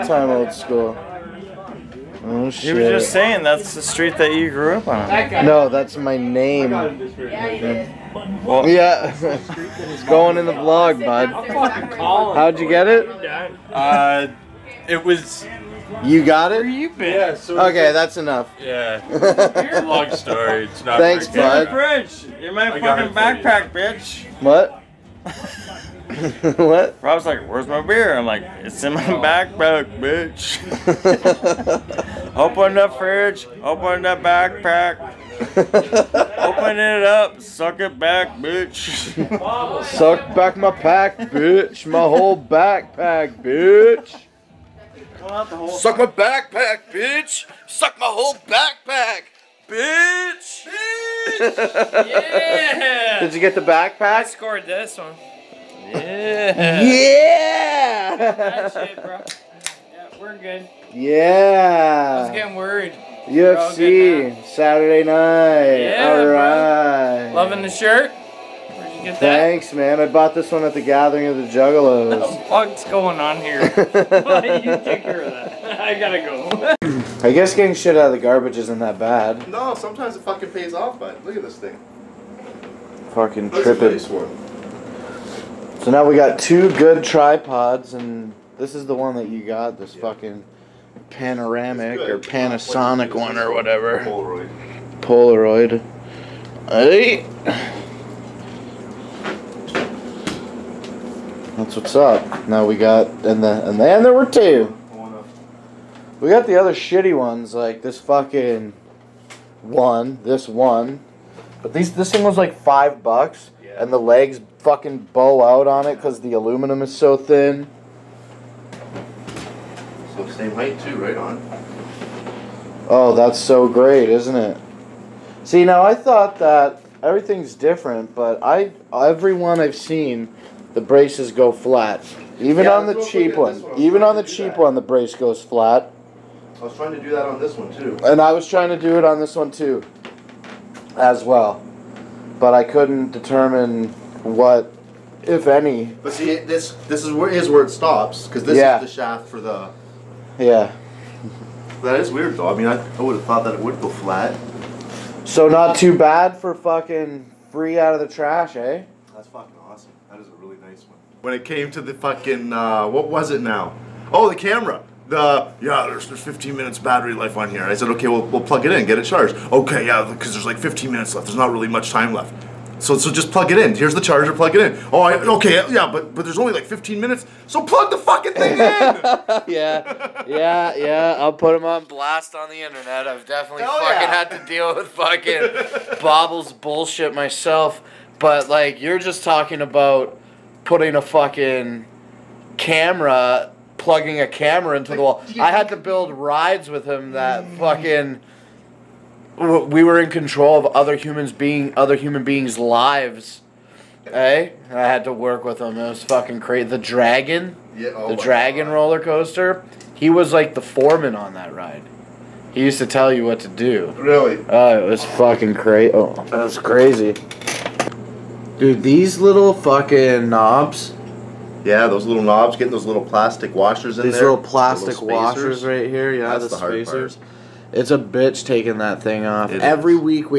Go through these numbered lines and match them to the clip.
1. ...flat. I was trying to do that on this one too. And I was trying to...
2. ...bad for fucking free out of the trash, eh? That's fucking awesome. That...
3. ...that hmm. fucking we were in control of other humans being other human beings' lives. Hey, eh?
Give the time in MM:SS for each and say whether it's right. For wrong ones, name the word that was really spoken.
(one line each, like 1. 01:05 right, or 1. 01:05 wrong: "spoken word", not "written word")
1. 02:15 right
2. 02:35 right
3. 03:17 right.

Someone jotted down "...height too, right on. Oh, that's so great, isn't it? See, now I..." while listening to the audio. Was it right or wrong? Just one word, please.
right.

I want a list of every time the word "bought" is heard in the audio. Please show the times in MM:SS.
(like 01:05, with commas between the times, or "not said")
01:10.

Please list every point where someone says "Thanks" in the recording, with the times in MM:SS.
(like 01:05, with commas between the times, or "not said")
00:20, 01:09.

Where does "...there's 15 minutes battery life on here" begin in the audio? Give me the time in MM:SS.
02:46.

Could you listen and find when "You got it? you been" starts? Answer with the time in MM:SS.
00:16.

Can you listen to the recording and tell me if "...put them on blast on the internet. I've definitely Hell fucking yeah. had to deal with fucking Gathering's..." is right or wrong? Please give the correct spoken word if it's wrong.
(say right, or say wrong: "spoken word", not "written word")
wrong: "Bobble", not "Gathering".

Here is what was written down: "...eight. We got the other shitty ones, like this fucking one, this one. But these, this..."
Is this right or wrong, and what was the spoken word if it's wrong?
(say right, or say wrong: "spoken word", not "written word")
wrong: "two", not "eight".